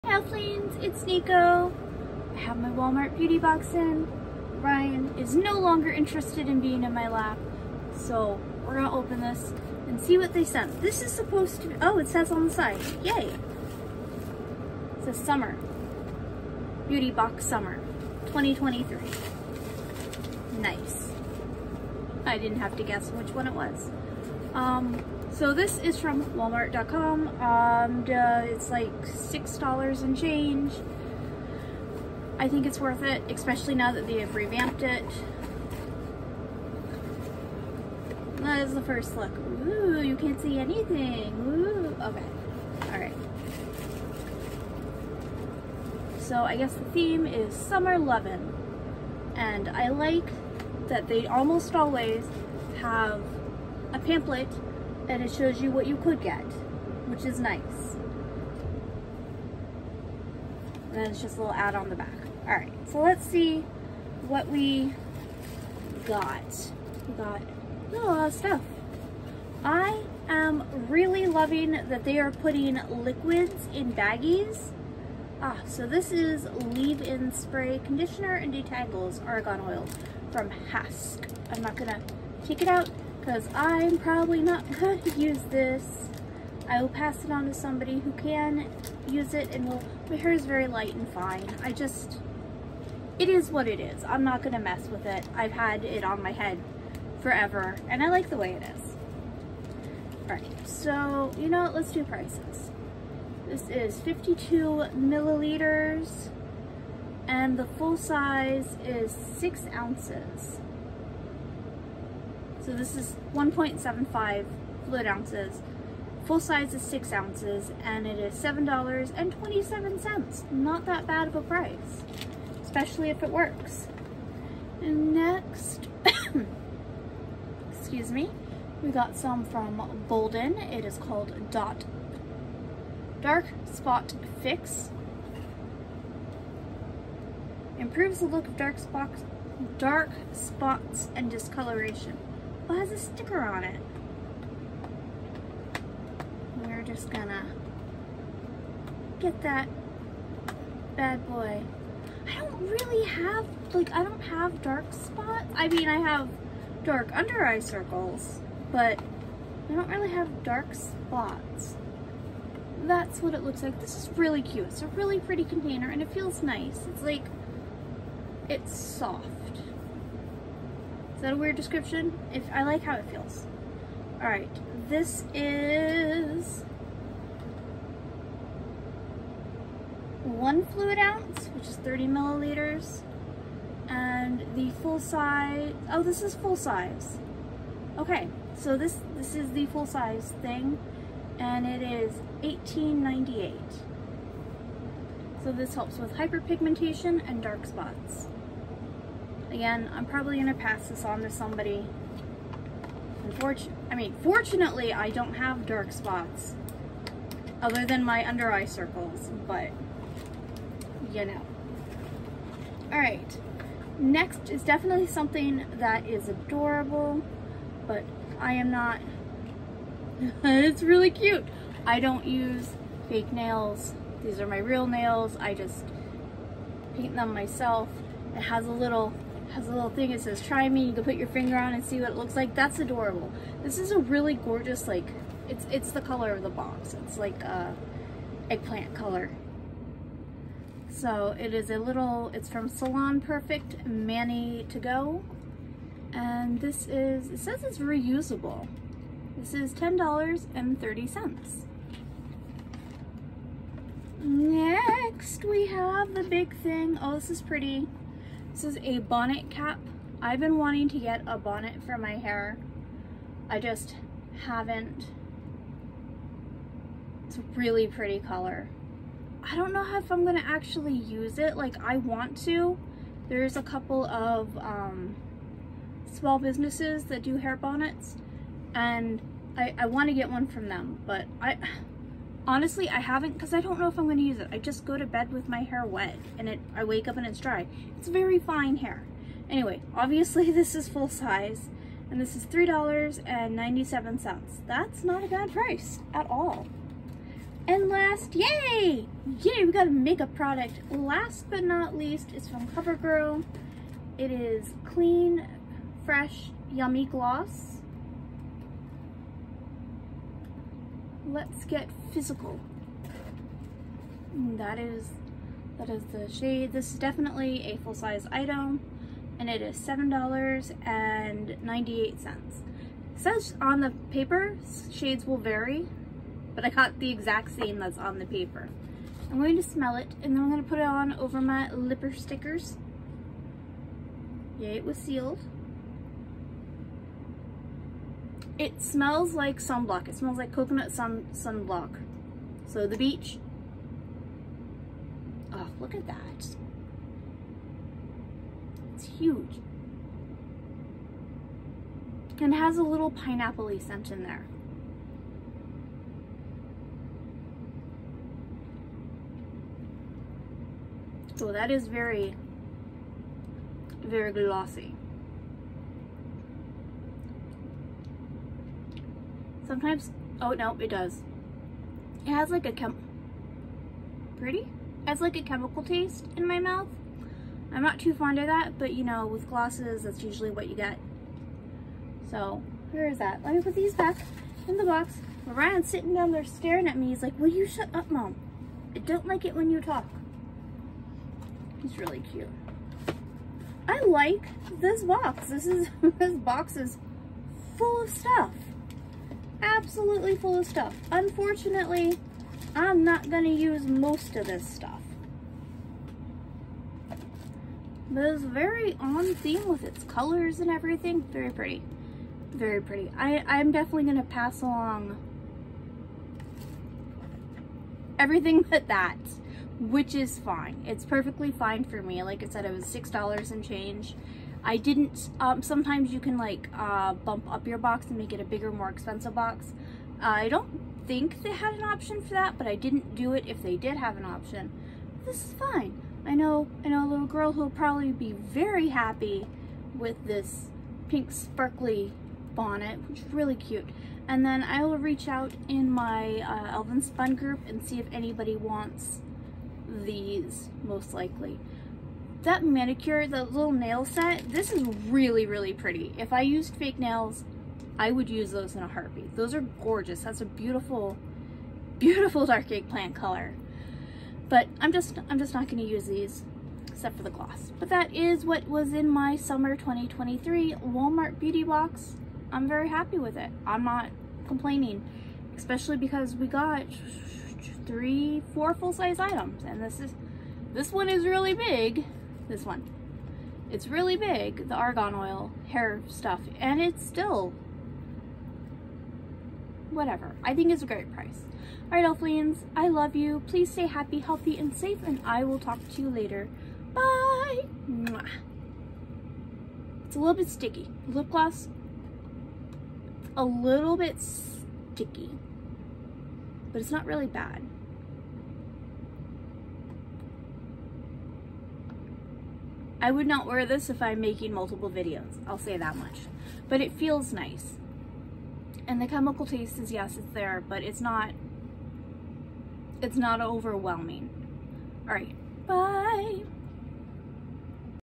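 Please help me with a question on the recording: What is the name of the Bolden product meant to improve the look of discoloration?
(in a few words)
Dot Dark Spot Fix.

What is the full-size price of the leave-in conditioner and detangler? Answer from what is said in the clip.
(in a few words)
$7.27.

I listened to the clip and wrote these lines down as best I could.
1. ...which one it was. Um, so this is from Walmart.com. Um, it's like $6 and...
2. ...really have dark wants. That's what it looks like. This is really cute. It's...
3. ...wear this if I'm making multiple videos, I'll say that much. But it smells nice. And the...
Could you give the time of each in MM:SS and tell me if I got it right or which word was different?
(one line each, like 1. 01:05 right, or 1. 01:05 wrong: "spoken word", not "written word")
1. 00:23 right
2. 02:39 wrong: "spots", not "wants"
3. 08:33 wrong: "feels", not "smells".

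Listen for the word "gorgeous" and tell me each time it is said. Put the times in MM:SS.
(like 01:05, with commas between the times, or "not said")
03:54, 07:39.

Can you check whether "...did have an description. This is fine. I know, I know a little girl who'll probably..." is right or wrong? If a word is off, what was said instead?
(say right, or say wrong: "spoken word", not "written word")
wrong: "option", not "description".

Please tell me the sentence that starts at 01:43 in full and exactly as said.
This is 52 milliliters and the full size is six ounces.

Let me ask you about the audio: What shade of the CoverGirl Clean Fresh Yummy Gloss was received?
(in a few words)
Let's Get Physical.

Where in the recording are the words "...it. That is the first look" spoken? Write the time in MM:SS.
00:34.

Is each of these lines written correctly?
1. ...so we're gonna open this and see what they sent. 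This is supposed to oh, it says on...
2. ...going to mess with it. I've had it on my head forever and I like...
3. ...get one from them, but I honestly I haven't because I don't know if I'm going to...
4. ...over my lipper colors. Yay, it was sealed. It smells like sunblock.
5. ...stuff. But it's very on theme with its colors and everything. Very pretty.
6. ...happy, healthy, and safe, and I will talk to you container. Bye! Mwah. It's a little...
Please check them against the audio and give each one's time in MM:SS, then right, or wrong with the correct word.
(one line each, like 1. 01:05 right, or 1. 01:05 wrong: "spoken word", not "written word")
1. 00:07 right
2. 01:34 right
3. 04:40 right
4. 05:31 wrong: "stickers", not "colors"
5. 06:44 right
6. 08:13 wrong: "later", not "container".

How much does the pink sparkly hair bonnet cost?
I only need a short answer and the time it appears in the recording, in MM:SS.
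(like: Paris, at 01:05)
$3.97, at 04:52.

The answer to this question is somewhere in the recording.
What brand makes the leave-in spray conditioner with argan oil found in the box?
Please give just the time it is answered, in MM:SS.
01:20.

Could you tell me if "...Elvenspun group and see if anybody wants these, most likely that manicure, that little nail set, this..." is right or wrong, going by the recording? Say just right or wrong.
right.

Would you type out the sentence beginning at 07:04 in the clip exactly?
I didn't, um, sometimes you can like uh, bump up your box and make it a bigger, more expensive box.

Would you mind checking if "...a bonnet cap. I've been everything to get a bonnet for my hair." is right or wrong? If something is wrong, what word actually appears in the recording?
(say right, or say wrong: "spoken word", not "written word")
wrong: "wanting", not "everything".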